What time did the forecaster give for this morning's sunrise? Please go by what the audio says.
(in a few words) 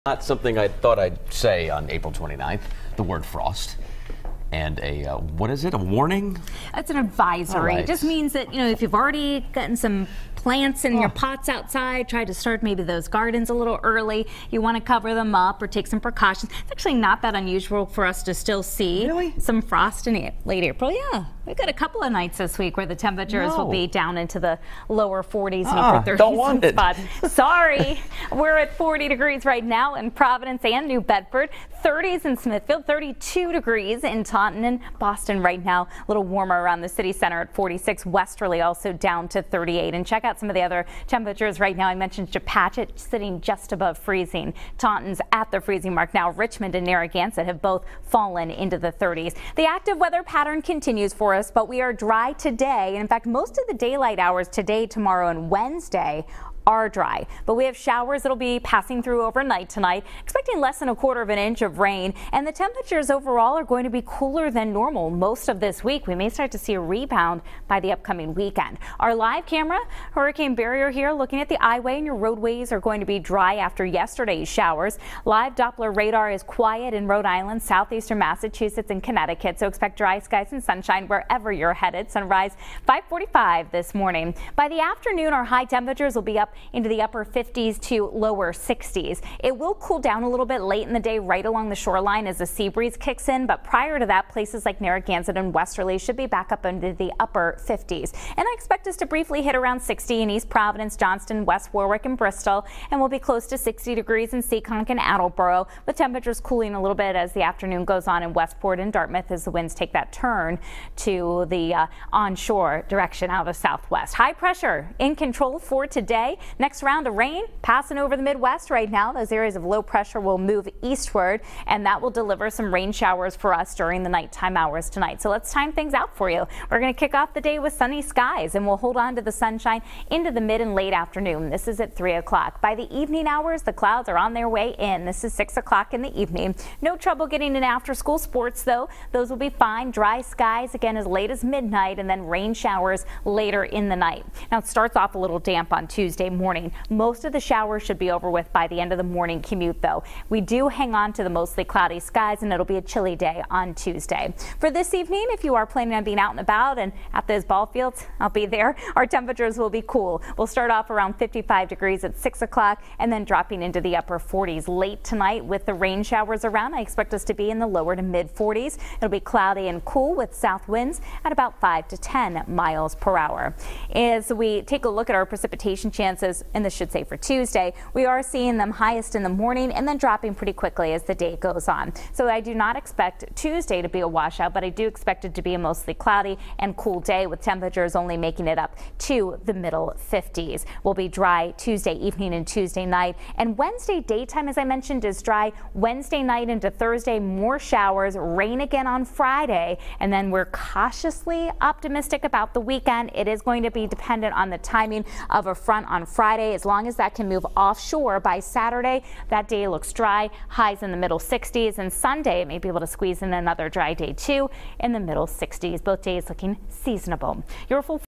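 5:45.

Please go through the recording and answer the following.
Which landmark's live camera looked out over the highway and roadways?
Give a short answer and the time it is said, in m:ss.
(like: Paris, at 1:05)
Hurricane Barrier, at 1:10.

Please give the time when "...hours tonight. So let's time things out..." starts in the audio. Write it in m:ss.
2:04.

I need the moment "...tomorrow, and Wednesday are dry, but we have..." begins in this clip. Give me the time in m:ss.
0:54.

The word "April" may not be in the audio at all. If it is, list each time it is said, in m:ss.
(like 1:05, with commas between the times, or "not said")
0:01, 0:20.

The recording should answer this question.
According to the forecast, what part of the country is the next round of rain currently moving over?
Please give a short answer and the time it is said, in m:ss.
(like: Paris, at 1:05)
Midwest, at 1:58.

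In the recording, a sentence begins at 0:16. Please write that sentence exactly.
It's actually not that unusual for us to still see really?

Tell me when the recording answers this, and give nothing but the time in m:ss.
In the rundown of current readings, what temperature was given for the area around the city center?
0:37.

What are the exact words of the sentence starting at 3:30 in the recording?
Highs in the middle 60s and Sunday, may be able to squeeze in another dry day too in the middle 60s.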